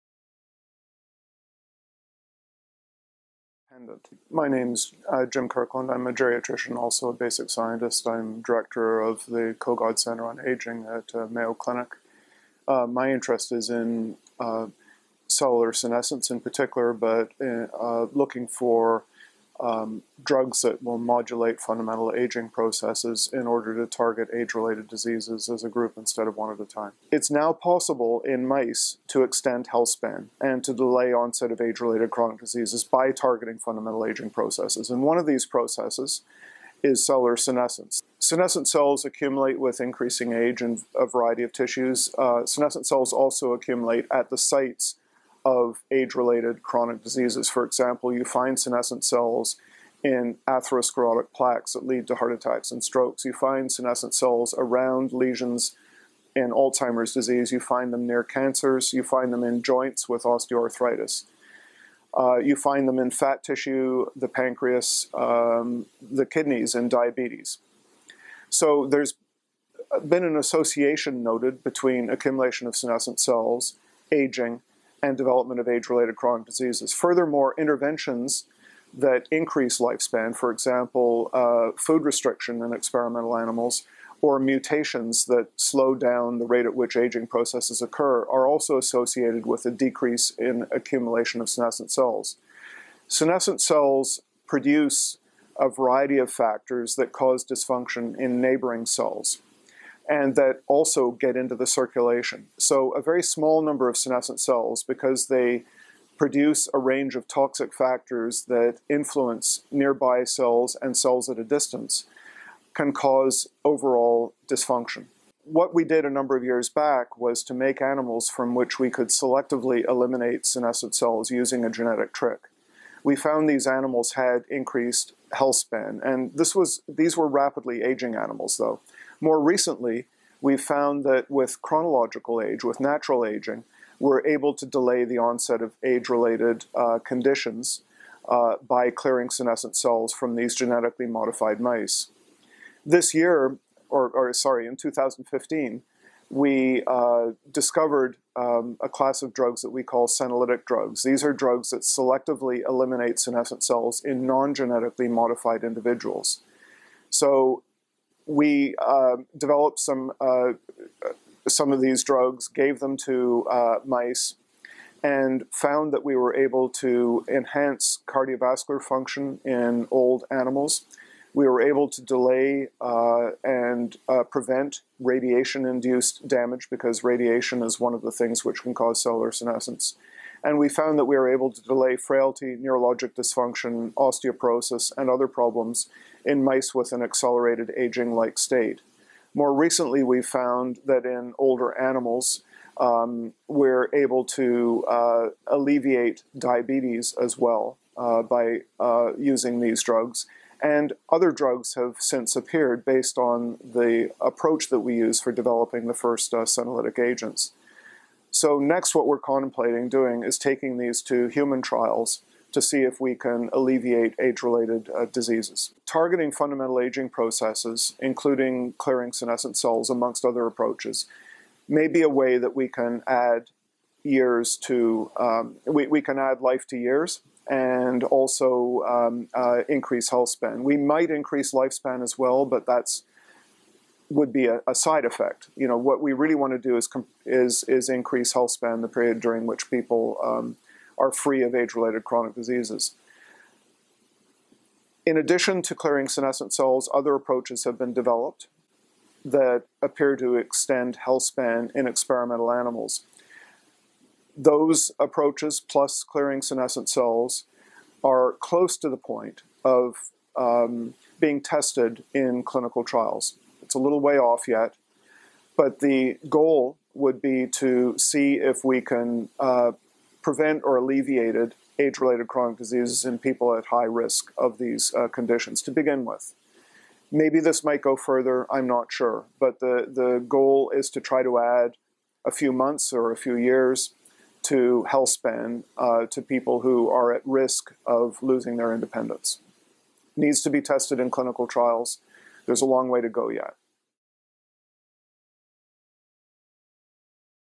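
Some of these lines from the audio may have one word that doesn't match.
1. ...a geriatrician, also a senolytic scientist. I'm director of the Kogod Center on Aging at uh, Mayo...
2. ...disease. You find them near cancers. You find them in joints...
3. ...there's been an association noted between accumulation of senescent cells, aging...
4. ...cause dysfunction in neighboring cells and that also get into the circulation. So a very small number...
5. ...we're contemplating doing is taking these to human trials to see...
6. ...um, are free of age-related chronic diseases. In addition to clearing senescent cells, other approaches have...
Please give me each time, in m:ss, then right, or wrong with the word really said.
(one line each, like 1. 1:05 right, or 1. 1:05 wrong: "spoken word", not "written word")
1. 0:06 wrong: "basic", not "senolytic"
2. 0:57 right
3. 1:08 right
4. 1:37 right
5. 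3:29 right
6. 4:00 right.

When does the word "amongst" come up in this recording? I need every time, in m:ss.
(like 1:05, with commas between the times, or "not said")
3:39.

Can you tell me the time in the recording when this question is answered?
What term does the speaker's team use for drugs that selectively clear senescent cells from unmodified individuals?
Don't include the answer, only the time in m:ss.
2:30.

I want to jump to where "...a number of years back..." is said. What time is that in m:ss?
1:56.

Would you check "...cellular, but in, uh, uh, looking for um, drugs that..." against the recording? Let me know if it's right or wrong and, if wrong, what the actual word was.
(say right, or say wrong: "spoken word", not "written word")
wrong: "particular", not "cellular".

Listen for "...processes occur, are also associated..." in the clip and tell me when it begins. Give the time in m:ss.
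1:27.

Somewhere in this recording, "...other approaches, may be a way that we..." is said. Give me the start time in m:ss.
3:40.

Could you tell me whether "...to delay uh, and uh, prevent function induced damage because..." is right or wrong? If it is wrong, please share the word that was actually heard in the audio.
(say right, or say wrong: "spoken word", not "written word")
wrong: "radiation", not "function".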